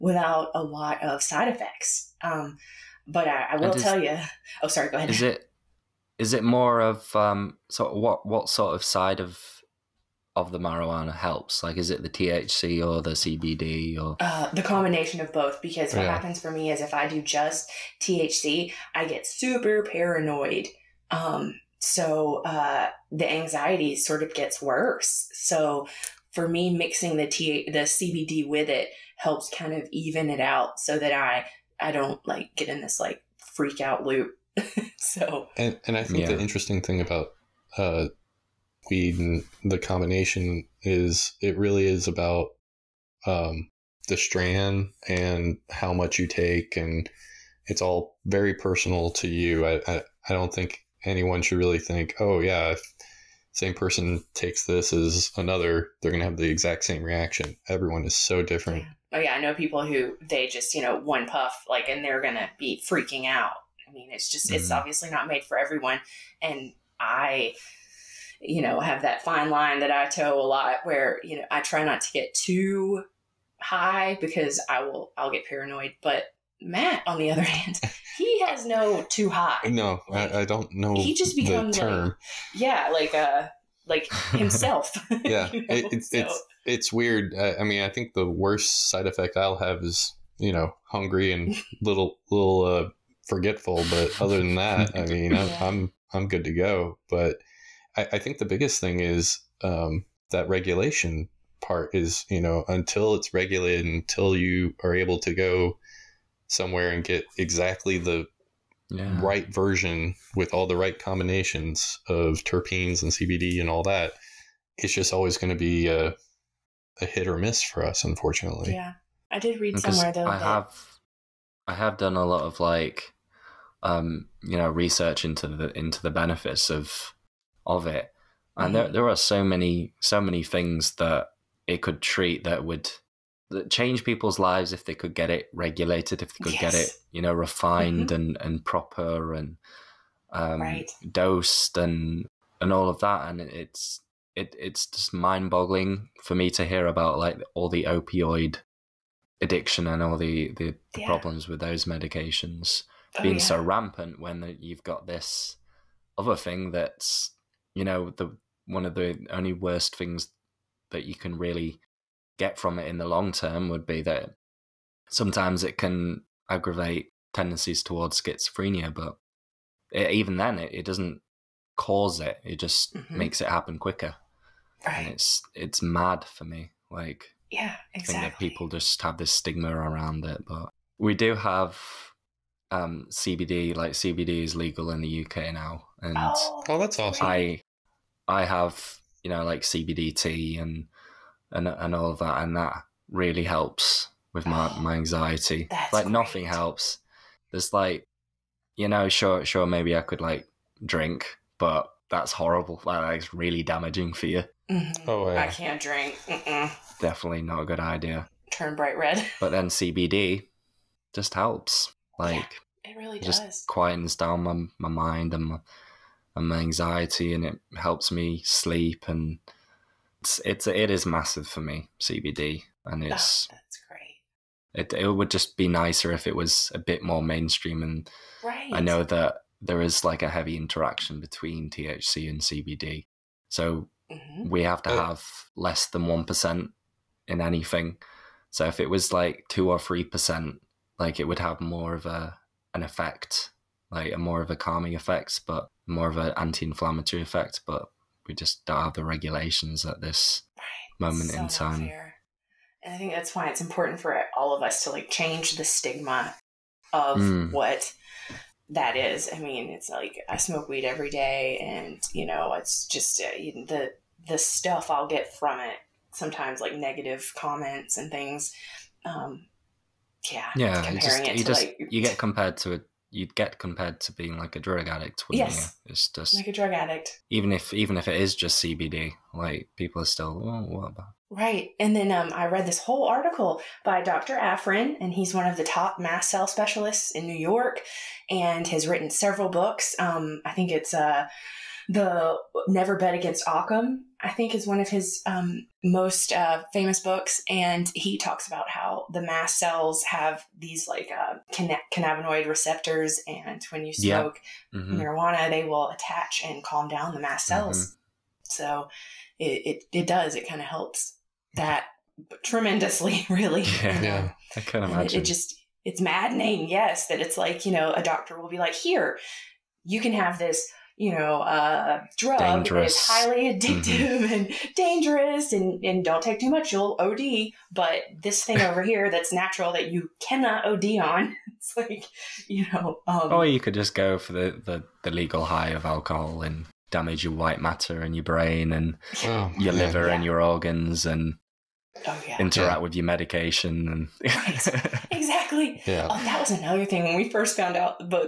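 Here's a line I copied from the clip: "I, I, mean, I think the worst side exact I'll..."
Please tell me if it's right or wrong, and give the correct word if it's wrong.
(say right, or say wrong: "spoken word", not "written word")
wrong: "effect", not "exact".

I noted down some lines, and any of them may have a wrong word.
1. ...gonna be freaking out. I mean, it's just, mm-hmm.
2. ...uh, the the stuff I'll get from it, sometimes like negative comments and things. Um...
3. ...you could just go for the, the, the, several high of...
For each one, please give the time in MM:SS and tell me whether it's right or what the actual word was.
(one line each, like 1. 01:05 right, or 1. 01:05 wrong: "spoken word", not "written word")
1. 01:02 right
2. 04:23 right
3. 05:33 wrong: "legal", not "several".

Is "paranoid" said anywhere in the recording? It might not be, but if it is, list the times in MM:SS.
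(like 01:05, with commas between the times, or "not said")
00:19, 01:15.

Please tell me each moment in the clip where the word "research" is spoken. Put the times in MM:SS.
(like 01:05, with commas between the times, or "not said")
02:04.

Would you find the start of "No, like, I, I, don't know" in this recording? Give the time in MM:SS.
01:19.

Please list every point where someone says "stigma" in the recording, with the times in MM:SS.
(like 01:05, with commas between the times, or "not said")
02:59, 04:15.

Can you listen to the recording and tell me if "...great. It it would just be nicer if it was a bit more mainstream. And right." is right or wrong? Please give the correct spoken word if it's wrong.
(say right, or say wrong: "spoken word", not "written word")
right.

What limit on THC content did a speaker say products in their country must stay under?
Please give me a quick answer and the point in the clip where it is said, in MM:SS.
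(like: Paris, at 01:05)
less than 1%, at 03:55.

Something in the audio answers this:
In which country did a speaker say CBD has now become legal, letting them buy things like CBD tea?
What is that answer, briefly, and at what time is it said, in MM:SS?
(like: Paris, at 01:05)
UK, at 03:05.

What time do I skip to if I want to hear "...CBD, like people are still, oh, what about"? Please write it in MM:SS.
04:38.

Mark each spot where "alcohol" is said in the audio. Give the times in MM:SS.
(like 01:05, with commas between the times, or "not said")
05:35.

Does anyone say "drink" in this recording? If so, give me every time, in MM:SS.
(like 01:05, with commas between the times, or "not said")
03:20, 03:25.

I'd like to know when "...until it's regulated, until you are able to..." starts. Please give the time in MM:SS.
01:42.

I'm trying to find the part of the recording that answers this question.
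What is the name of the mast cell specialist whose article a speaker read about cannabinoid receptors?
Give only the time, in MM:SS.
04:44.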